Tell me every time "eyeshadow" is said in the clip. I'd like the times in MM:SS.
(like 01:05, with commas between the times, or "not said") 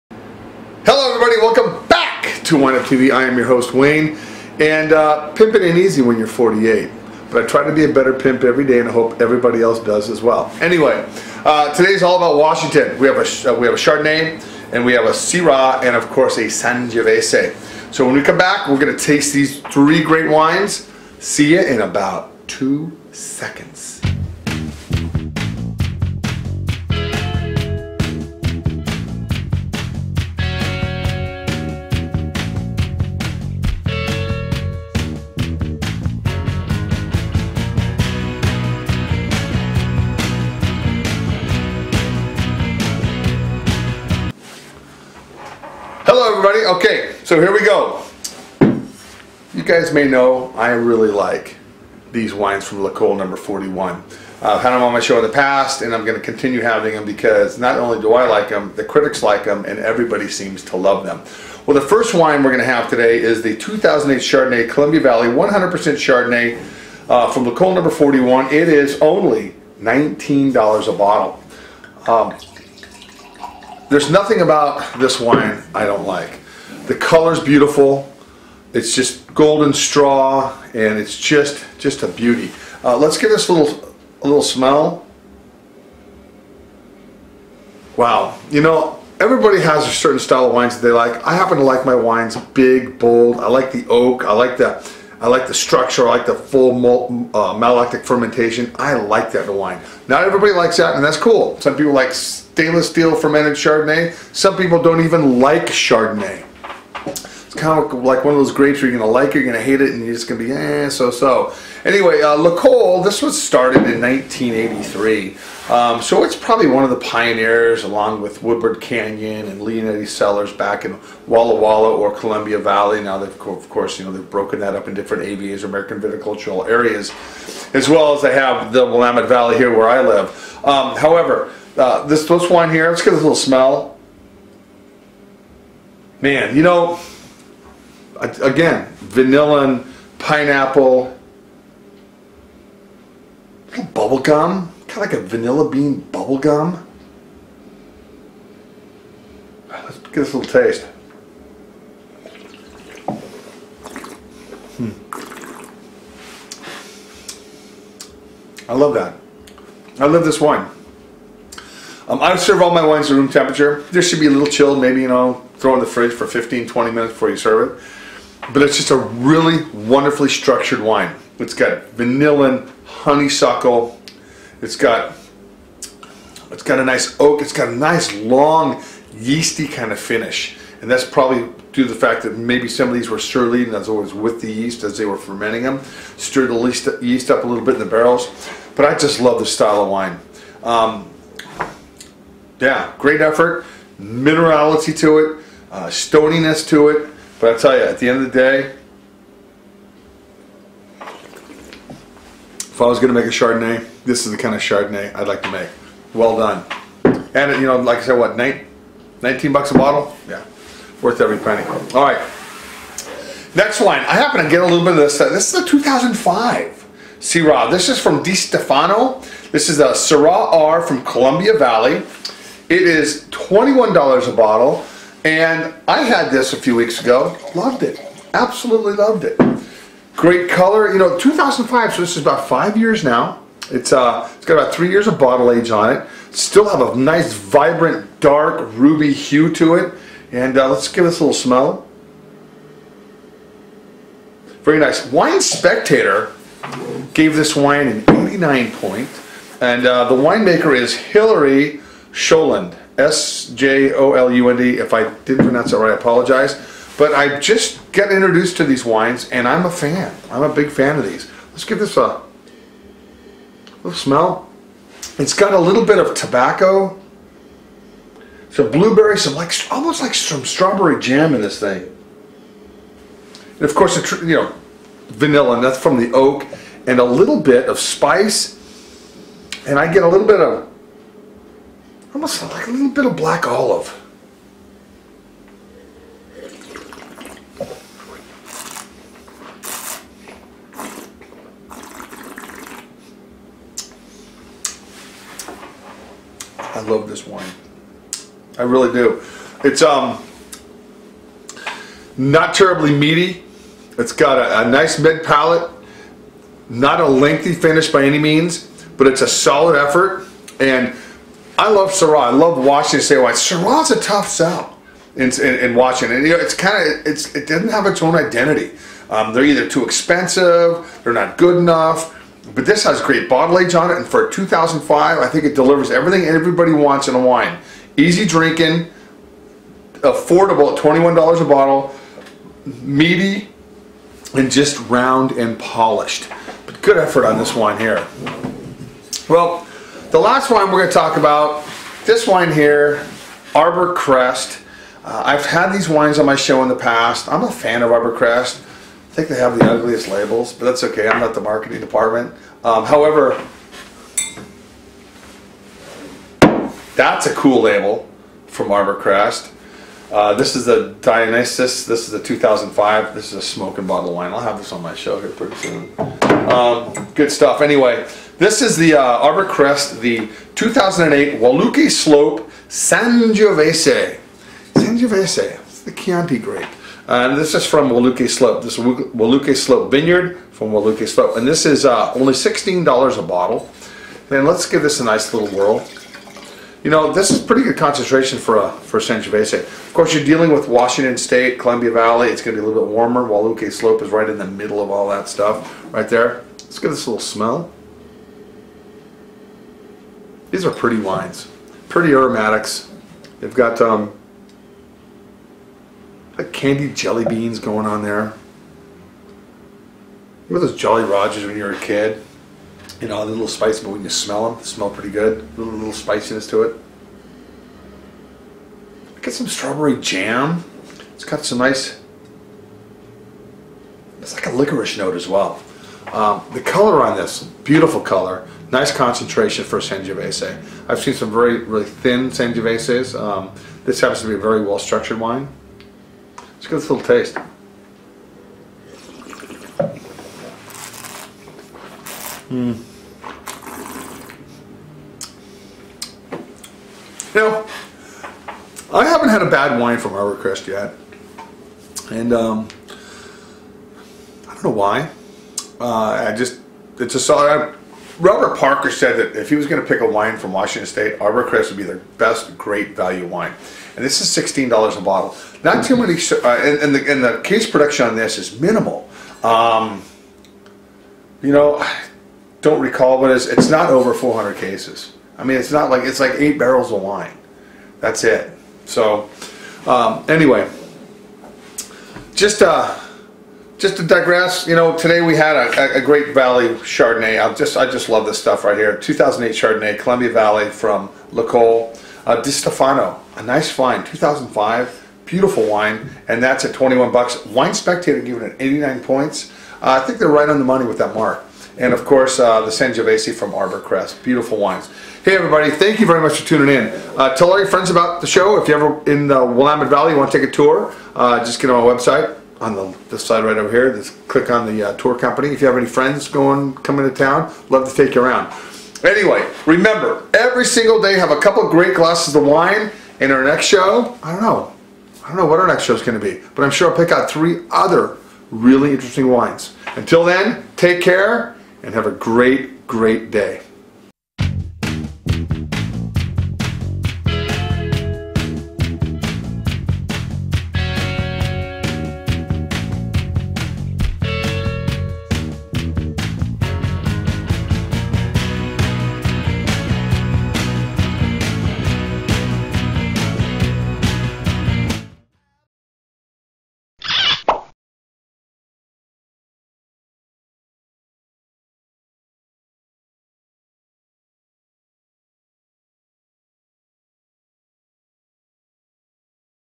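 not said.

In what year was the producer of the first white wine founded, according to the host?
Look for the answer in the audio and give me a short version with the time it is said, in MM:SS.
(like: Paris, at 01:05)
1983, at 01:53.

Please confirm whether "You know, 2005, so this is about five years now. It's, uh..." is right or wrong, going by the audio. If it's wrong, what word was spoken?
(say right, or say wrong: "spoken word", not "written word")
right.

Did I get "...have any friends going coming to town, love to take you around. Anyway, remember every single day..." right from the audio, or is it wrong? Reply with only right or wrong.
right.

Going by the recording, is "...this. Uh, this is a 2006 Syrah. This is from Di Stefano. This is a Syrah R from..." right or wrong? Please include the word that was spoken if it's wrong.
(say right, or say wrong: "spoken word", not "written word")
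wrong: "2005", not "2006".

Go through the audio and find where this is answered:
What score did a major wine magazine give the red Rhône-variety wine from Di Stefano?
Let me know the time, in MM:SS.
04:08.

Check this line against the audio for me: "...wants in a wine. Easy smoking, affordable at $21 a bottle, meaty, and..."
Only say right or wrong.
wrong.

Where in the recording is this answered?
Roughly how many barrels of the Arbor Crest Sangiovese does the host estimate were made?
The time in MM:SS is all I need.
07:56.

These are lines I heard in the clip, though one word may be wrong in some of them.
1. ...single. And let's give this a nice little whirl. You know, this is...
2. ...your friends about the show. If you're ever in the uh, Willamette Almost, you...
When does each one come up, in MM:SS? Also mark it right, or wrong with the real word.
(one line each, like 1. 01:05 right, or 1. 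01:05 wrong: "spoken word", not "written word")
1. 06:23 wrong: "bottle", not "single"
2. 08:27 wrong: "Valley", not "Almost".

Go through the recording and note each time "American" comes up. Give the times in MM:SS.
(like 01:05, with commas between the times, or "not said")
02:05.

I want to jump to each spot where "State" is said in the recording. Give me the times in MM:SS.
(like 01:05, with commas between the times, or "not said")
05:13, 06:31, 07:40.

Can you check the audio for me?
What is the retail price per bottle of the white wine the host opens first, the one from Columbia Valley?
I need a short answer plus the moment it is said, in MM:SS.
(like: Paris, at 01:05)
$19, at 01:09.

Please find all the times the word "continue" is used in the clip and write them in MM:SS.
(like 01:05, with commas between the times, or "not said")
00:56.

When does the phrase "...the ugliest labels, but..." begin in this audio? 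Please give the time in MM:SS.
05:49.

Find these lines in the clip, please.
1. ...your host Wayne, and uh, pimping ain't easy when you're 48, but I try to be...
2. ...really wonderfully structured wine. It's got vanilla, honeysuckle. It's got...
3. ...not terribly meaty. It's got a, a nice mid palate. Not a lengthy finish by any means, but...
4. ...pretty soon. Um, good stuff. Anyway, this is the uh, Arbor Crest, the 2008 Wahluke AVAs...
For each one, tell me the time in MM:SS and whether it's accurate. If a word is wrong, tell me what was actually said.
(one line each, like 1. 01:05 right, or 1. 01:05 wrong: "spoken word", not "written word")
1. 00:03 right
2. 02:48 right
3. 05:02 right
4. 06:05 wrong: "Slope", not "AVAs".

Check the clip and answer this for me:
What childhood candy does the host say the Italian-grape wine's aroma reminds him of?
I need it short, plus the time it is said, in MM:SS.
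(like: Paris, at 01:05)
Jolly Rogers, at 06:50.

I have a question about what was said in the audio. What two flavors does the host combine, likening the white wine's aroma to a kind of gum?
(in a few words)
vanilla bean bubble gum.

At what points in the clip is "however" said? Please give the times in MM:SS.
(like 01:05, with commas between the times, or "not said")
02:10, 05:52.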